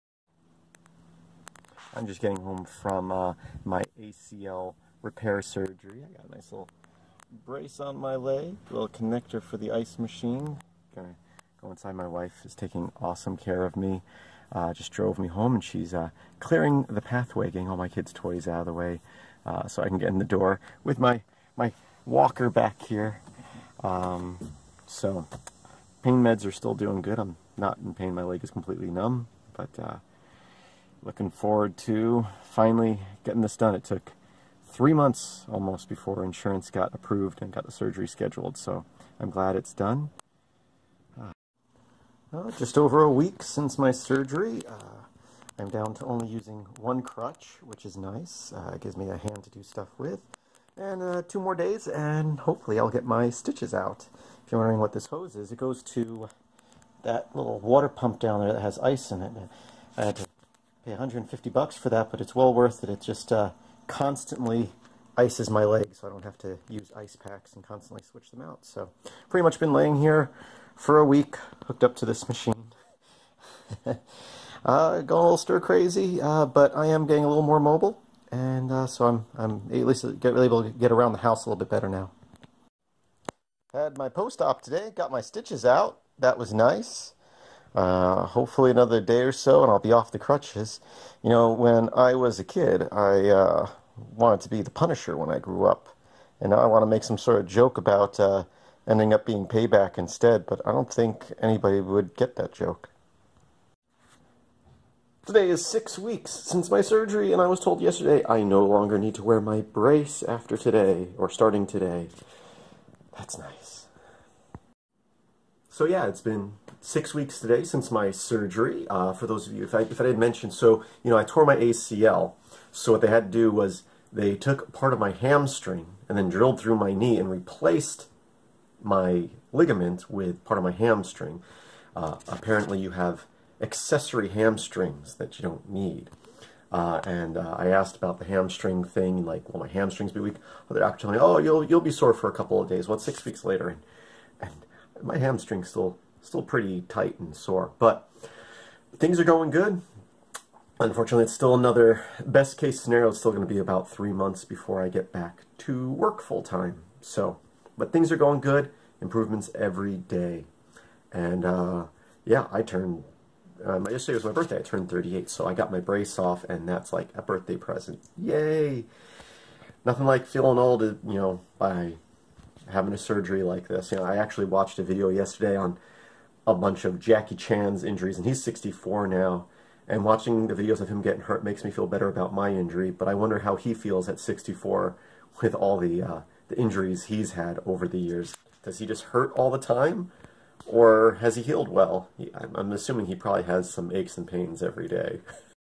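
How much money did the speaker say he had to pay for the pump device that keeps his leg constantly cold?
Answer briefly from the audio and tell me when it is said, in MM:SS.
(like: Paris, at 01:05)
$150, at 01:00.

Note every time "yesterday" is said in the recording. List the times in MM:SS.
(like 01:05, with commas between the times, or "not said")
01:47, 02:43, 02:55.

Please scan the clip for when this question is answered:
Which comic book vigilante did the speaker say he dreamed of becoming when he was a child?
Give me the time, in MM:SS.
01:34.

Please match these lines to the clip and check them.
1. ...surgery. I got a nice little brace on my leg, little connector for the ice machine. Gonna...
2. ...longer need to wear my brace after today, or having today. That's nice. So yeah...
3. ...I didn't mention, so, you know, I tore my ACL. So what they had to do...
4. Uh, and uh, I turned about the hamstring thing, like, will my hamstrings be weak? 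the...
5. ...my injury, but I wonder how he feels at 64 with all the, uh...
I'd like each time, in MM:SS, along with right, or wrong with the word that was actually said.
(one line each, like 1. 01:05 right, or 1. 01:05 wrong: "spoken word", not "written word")
1. 00:05 right
2. 01:48 wrong: "starting", not "having"
3. 02:00 right
4. 02:16 wrong: "asked", not "turned"
5. 03:02 right.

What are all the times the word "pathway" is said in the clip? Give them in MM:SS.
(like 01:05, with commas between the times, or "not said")
00:17.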